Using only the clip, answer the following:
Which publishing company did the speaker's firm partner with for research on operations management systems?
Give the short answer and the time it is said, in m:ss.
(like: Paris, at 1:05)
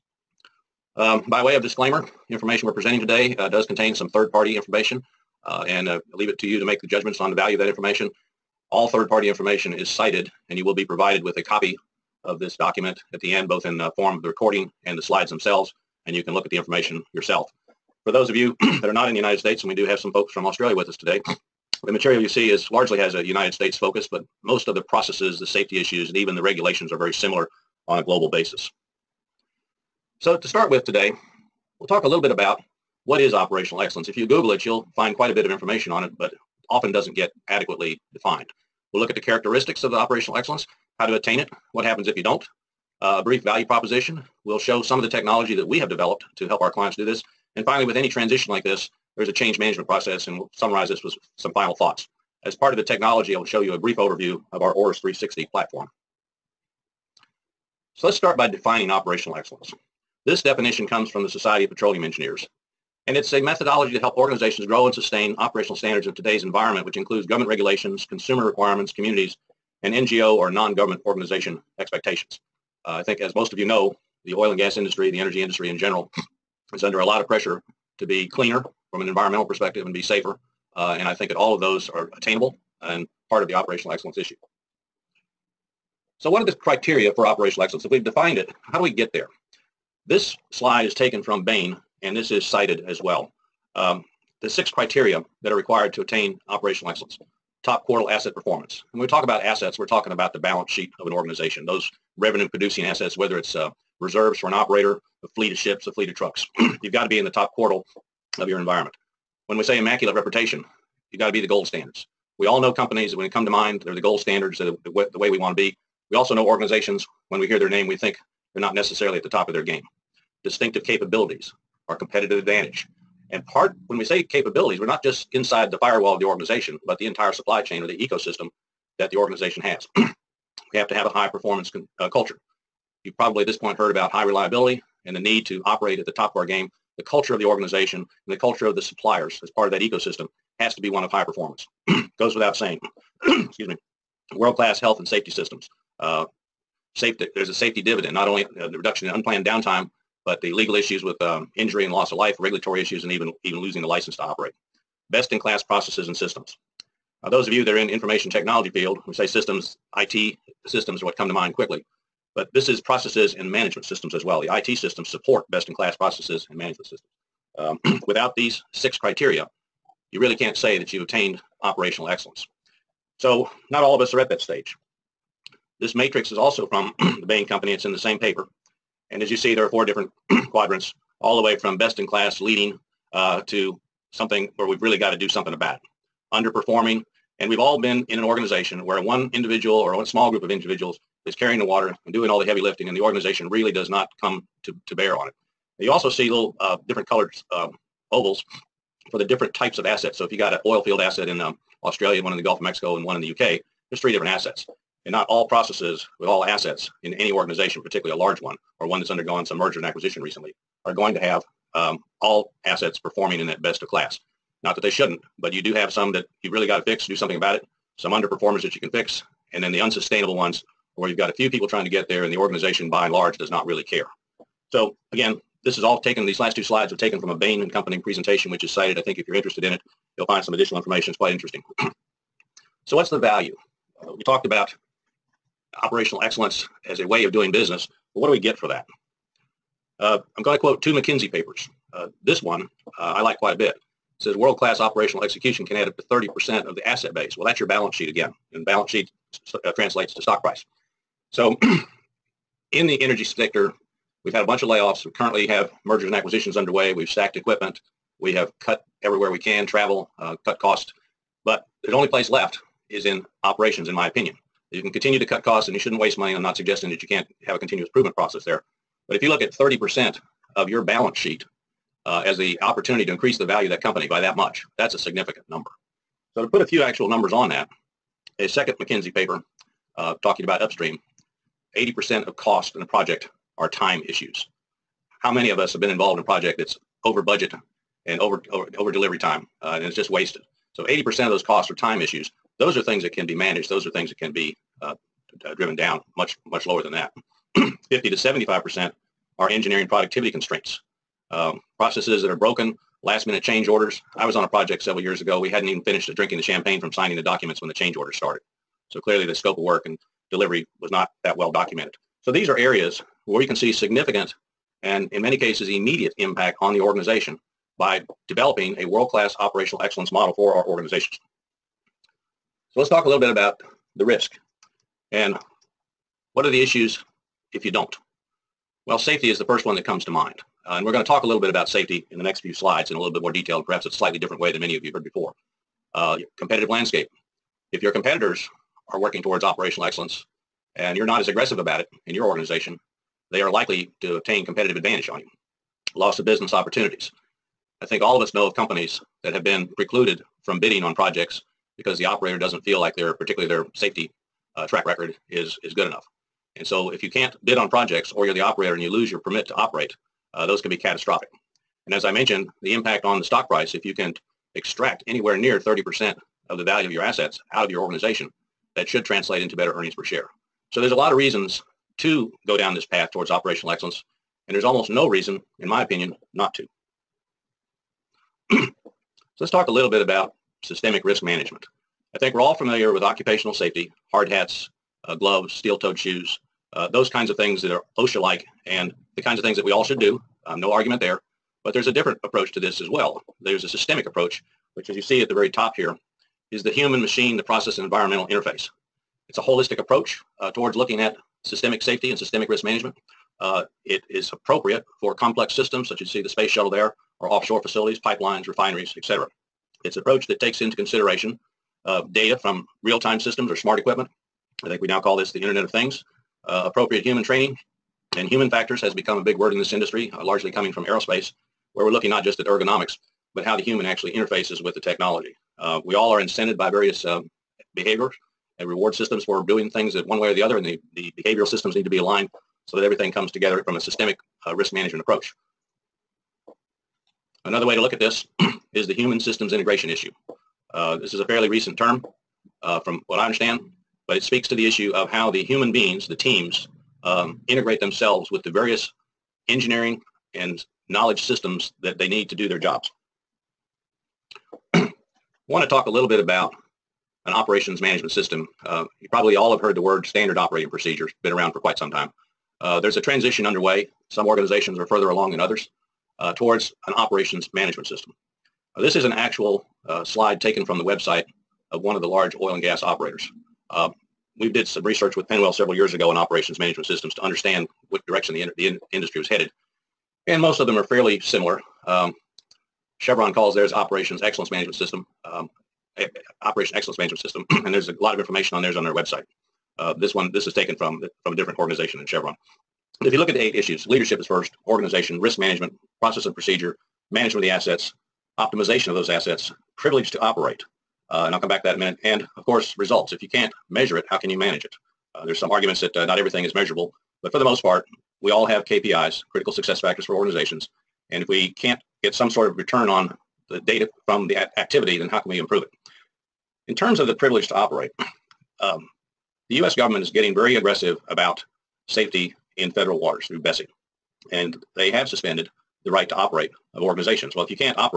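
PennWell, at 7:55.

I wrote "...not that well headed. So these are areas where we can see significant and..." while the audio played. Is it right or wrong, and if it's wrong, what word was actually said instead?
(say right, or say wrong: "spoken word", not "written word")
wrong: "documented", not "headed".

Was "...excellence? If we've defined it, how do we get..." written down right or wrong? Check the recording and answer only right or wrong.
right.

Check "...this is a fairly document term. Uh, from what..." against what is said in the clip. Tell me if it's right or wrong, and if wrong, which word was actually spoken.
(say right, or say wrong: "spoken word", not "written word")
wrong: "recent", not "document".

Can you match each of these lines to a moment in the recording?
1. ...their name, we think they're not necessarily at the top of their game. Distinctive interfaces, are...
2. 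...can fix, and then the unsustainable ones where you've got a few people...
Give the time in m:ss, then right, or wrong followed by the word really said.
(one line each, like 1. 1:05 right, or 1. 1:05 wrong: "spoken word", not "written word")
1. 1:57 wrong: "capabilities", not "interfaces"
2. 3:38 right.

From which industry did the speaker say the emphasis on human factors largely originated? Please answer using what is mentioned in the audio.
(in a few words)
aerospace.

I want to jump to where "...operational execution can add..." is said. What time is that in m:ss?
4:04.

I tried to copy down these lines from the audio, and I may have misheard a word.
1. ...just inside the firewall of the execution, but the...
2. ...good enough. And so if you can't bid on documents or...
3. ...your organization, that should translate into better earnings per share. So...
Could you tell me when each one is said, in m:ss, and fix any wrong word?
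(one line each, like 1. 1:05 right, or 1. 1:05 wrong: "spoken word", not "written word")
1. 2:05 wrong: "organization", not "execution"
2. 5:55 wrong: "projects", not "documents"
3. 6:07 right.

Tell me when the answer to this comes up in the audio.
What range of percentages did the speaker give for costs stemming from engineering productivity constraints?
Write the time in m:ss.
4:57.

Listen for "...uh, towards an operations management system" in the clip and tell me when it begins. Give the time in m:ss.
7:46.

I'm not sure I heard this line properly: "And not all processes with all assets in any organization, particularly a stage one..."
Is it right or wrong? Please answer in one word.
wrong.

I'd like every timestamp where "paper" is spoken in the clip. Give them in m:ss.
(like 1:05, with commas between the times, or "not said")
2:58, 4:01, 4:39.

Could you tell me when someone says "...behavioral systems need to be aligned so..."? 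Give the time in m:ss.
7:11.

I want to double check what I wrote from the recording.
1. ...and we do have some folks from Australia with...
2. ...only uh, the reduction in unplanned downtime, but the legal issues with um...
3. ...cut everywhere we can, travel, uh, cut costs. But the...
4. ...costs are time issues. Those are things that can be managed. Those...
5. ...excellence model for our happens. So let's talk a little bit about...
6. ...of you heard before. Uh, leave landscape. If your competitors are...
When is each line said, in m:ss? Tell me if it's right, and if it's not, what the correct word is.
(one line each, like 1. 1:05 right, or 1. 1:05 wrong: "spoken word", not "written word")
1. 0:19 right
2. 2:28 right
3. 4:18 right
4. 4:51 right
5. 5:19 wrong: "organizations", not "happens"
6. 5:34 wrong: "competitive", not "leave".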